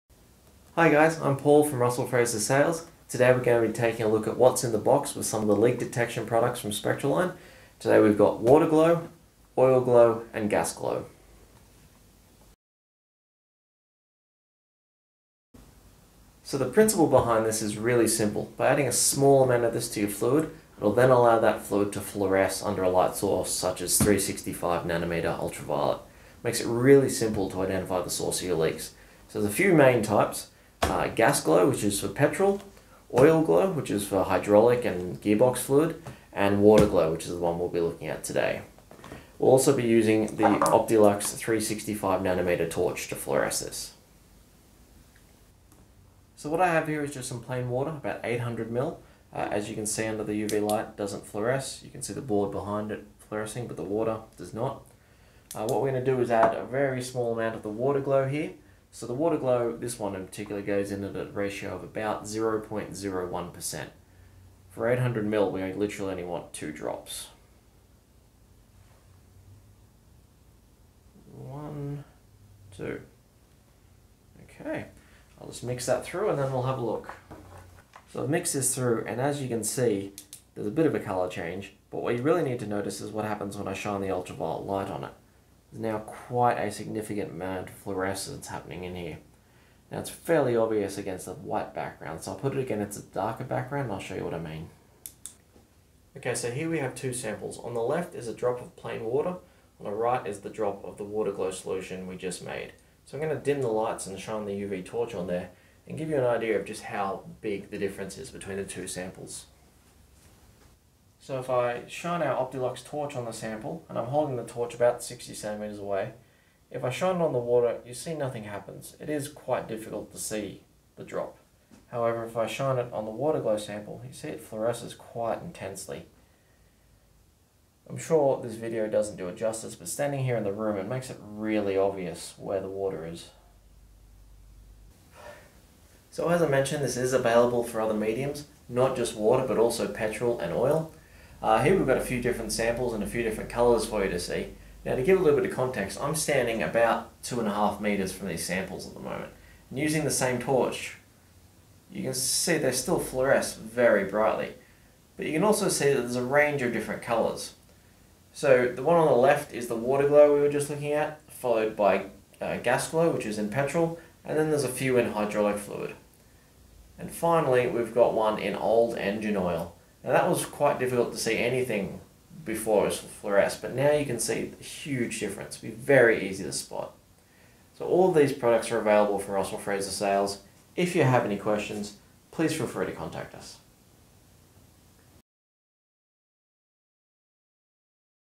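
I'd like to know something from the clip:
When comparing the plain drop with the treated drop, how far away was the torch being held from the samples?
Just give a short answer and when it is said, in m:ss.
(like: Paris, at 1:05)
60 centimeters, at 1:54.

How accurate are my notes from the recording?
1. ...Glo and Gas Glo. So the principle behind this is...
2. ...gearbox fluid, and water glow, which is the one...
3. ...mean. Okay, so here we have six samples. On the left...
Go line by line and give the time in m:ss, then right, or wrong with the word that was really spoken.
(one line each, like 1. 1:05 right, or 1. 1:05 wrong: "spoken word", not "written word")
1. 0:09 right
2. 0:35 right
3. 1:34 wrong: "two", not "six".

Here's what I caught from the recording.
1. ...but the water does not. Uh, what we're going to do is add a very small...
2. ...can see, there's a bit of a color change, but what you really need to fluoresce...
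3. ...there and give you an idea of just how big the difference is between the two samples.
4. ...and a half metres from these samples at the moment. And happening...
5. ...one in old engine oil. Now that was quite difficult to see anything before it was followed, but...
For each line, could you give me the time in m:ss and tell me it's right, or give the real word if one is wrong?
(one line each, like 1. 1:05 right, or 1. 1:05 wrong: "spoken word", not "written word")
1. 0:53 right
2. 1:19 wrong: "notice", not "fluoresce"
3. 1:45 right
4. 2:27 wrong: "using", not "happening"
5. 2:48 wrong: "fluoresced", not "followed".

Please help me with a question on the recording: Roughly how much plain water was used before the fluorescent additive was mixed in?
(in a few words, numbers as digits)
800 ml.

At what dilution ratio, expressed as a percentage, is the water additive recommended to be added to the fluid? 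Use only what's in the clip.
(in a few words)
0.01%.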